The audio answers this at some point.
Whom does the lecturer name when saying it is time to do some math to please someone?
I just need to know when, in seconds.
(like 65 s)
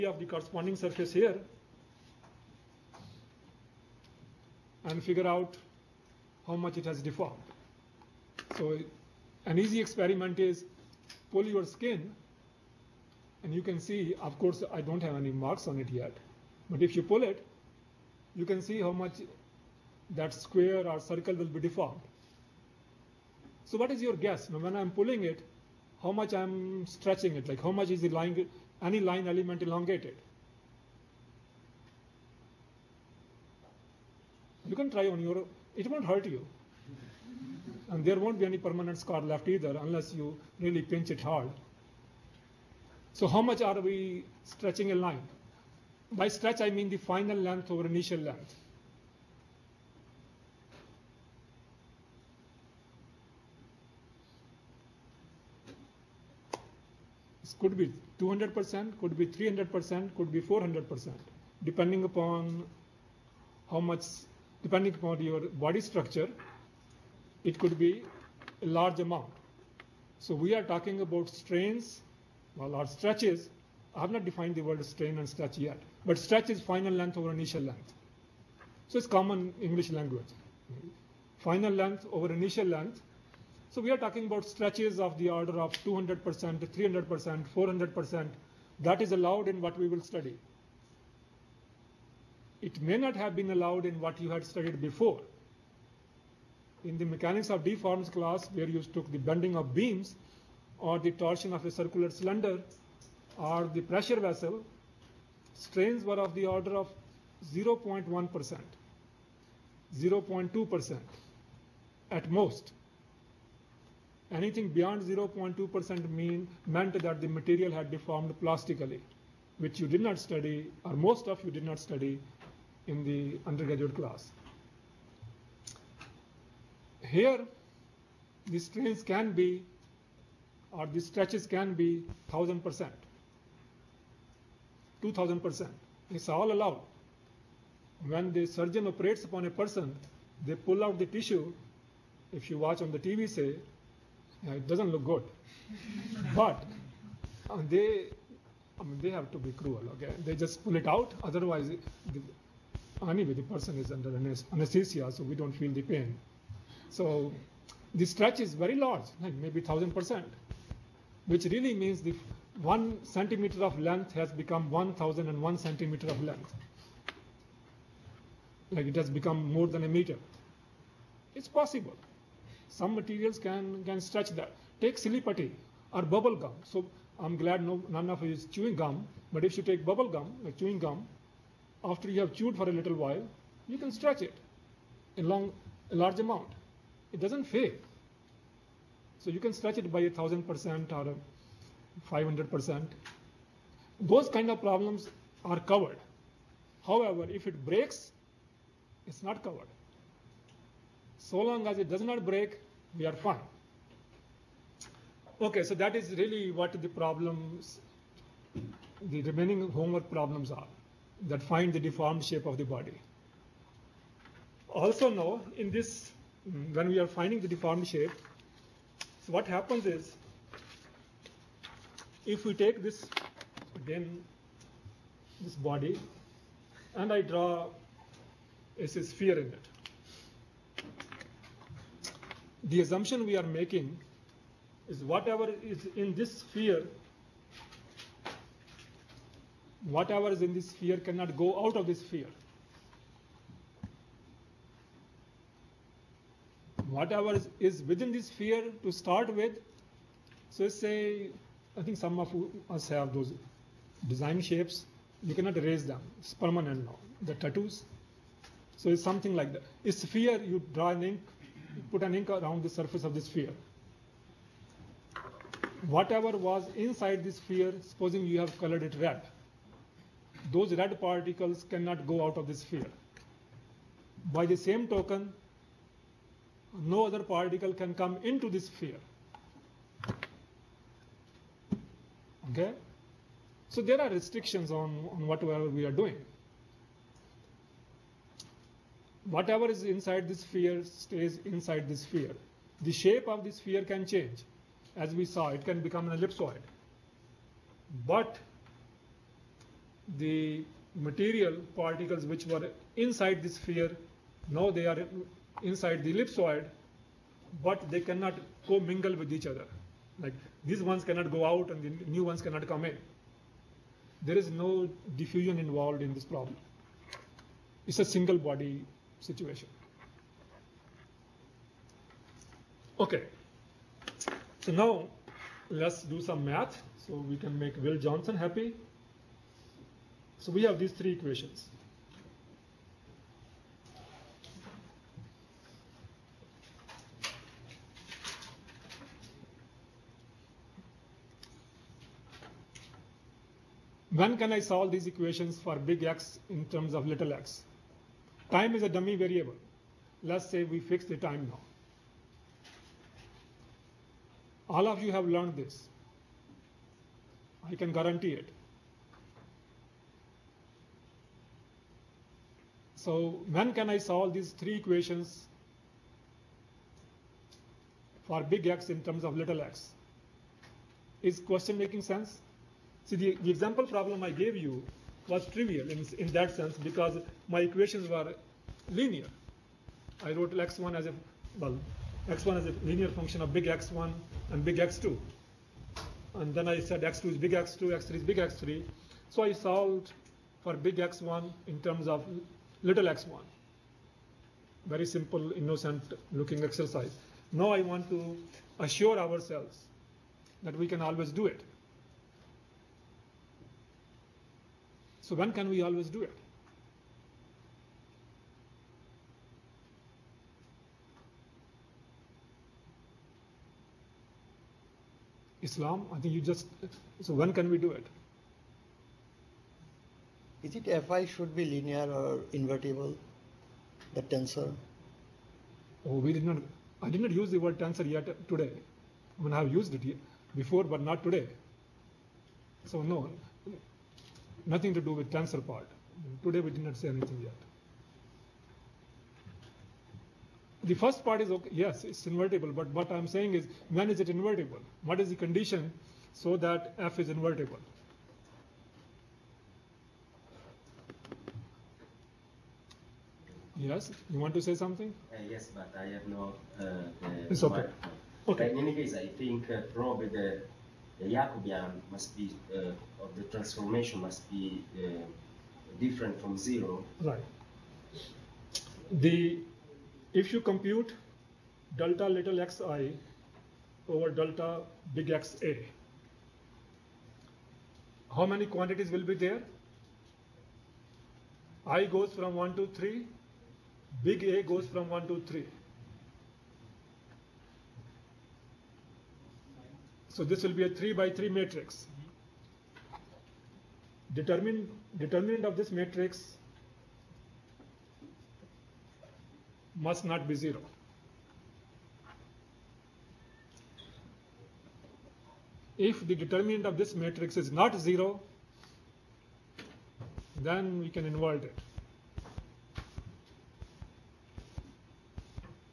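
327 s.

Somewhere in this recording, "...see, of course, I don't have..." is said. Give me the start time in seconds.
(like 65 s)
13 s.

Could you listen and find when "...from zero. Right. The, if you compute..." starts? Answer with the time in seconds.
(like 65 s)
466 s.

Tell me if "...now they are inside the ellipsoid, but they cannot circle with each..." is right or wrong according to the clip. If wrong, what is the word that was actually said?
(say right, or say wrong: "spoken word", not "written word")
wrong: "commingle", not "circle".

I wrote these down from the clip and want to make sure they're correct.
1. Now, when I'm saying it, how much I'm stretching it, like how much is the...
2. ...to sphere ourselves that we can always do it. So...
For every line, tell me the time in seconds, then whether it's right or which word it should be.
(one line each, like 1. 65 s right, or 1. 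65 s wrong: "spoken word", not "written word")
1. 24 s wrong: "pulling", not "saying"
2. 398 s wrong: "assure", not "sphere".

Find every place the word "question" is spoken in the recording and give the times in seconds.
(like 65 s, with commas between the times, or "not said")
371 s.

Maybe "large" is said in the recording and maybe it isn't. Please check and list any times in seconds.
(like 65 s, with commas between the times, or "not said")
68 s, 158 s, 185 s.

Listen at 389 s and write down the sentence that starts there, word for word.
So I solved for big X1 in terms of little x1.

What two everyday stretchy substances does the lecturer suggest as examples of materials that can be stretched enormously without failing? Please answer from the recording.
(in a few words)
Silly Putty or bubble gum.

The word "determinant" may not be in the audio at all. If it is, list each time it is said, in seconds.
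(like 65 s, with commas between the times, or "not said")
494 s, 506 s.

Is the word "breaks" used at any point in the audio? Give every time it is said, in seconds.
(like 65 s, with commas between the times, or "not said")
197 s, 202 s.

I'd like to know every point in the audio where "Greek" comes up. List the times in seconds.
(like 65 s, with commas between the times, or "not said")
not said.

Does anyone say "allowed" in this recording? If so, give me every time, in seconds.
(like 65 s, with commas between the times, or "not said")
89 s, 93 s, 136 s.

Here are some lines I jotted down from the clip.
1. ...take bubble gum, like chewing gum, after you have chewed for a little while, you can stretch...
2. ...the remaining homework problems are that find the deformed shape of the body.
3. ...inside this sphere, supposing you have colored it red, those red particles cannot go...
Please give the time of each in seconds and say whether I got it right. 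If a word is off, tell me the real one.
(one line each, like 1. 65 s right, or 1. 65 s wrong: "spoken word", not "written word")
1. 179 s right
2. 208 s right
3. 266 s right.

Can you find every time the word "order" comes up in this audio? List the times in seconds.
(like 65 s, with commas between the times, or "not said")
85 s, 106 s.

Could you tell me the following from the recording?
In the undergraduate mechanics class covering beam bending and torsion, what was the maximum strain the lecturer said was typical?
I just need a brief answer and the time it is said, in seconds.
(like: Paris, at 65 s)
0.2%, at 109 s.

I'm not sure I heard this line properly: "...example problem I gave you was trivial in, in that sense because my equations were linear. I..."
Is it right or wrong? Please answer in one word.
right.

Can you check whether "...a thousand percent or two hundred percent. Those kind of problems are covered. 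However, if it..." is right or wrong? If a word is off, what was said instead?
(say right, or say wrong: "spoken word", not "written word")
wrong: "five", not "two".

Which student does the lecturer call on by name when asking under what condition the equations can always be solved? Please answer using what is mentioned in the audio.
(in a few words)
Islam.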